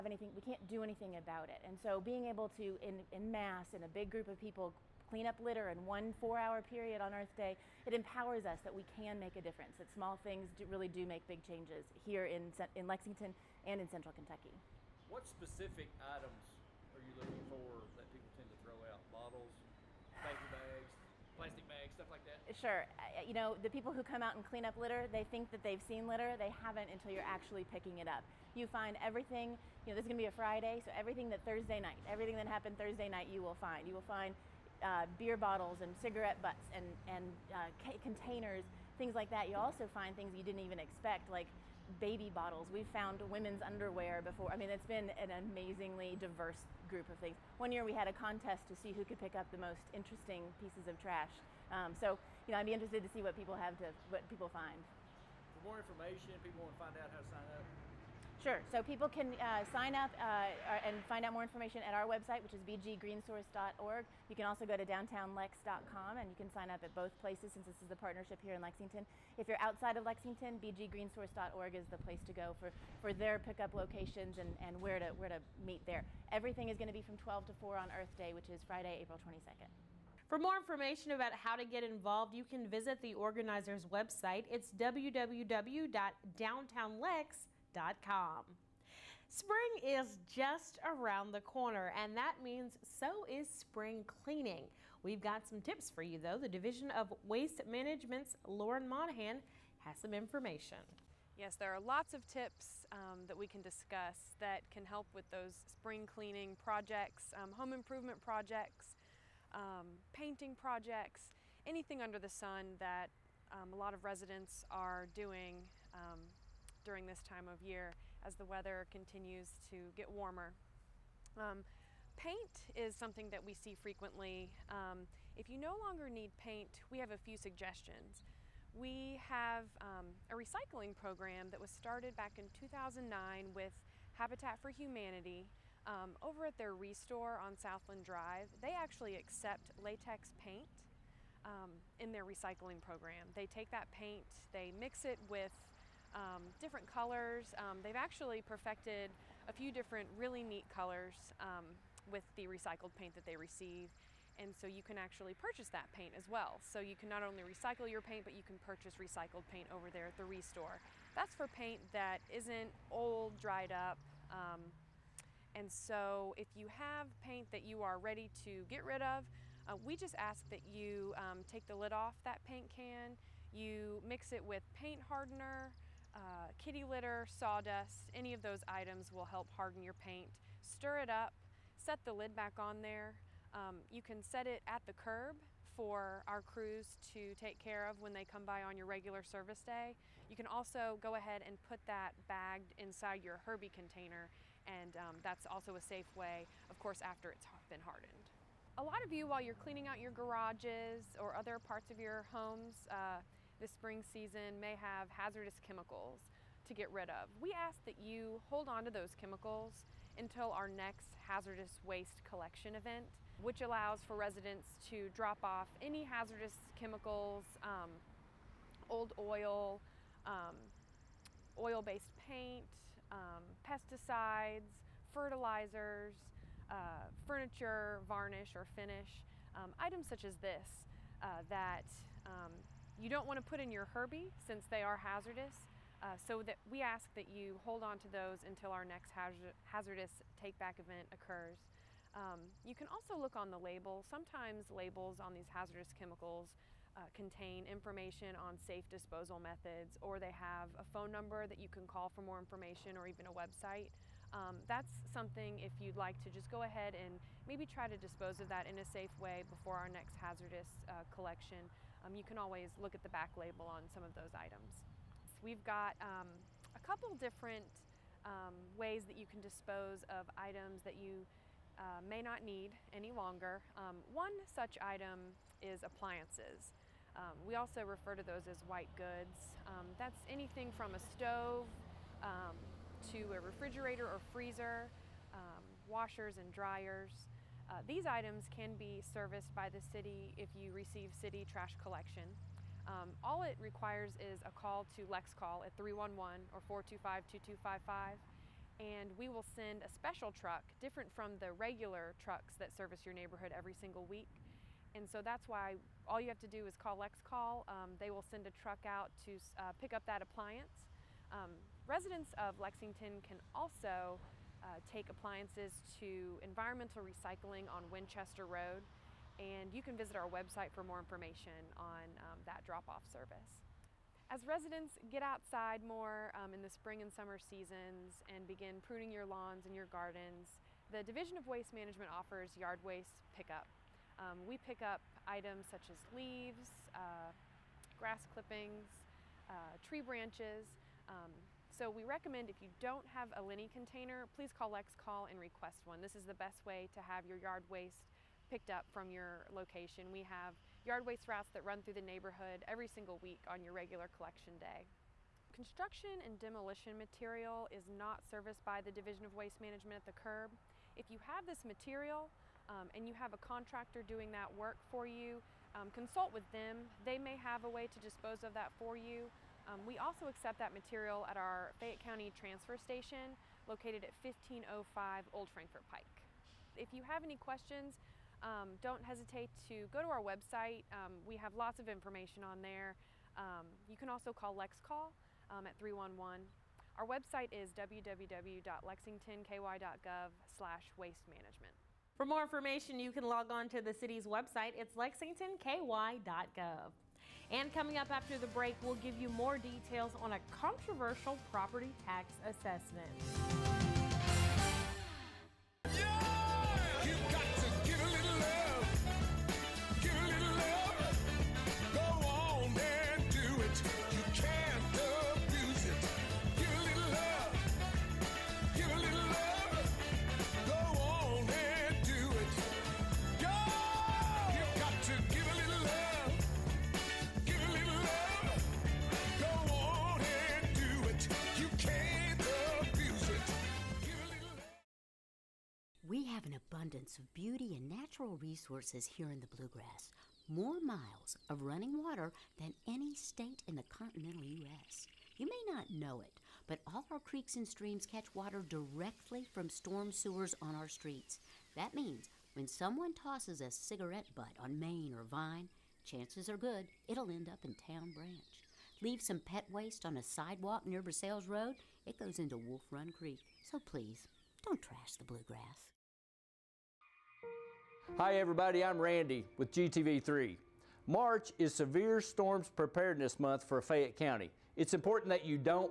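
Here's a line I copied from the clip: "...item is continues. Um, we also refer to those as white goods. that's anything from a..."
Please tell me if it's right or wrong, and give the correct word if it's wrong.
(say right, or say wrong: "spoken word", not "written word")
wrong: "appliances", not "continues".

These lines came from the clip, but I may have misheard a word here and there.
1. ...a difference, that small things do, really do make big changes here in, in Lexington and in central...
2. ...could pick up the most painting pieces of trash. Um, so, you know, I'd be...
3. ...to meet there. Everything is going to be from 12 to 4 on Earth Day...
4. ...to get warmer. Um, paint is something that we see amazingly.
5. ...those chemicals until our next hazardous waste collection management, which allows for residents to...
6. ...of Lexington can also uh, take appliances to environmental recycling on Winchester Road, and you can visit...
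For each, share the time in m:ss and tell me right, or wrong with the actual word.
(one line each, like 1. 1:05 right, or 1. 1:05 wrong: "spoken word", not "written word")
1. 0:09 right
2. 0:49 wrong: "interesting", not "painting"
3. 1:15 right
4. 1:59 wrong: "frequently", not "amazingly"
5. 3:28 wrong: "event", not "management"
6. 5:12 right.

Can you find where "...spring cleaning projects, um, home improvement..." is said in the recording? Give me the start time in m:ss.
1:45.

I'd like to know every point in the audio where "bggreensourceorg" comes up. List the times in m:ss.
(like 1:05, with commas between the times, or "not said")
1:02, 1:10.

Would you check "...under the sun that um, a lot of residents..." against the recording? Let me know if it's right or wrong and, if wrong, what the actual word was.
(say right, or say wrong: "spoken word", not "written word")
right.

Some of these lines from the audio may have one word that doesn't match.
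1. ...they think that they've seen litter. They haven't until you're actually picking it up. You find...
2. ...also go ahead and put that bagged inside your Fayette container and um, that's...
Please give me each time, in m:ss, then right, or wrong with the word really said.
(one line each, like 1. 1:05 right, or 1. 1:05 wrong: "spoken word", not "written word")
1. 0:25 right
2. 3:10 wrong: "Herbie", not "Fayette".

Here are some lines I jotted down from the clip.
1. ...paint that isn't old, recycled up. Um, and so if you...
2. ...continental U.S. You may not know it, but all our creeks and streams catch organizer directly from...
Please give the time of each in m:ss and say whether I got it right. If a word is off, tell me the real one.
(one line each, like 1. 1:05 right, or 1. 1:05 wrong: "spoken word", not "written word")
1. 2:41 wrong: "dried", not "recycled"
2. 7:23 wrong: "water", not "organizer".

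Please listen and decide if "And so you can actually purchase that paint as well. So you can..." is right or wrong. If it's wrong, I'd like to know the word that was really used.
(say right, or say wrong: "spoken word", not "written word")
right.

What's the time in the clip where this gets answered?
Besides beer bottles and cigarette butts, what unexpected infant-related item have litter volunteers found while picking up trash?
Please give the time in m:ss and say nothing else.
0:41.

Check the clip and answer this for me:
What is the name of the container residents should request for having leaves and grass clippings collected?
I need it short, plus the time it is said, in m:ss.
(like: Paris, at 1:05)
Lenny, at 5:43.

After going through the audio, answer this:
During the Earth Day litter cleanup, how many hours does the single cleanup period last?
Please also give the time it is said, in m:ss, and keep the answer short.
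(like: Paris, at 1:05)
4, at 0:06.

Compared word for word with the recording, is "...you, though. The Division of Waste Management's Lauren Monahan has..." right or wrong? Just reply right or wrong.
right.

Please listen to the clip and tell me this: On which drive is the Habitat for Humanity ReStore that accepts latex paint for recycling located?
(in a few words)
Southland Drive.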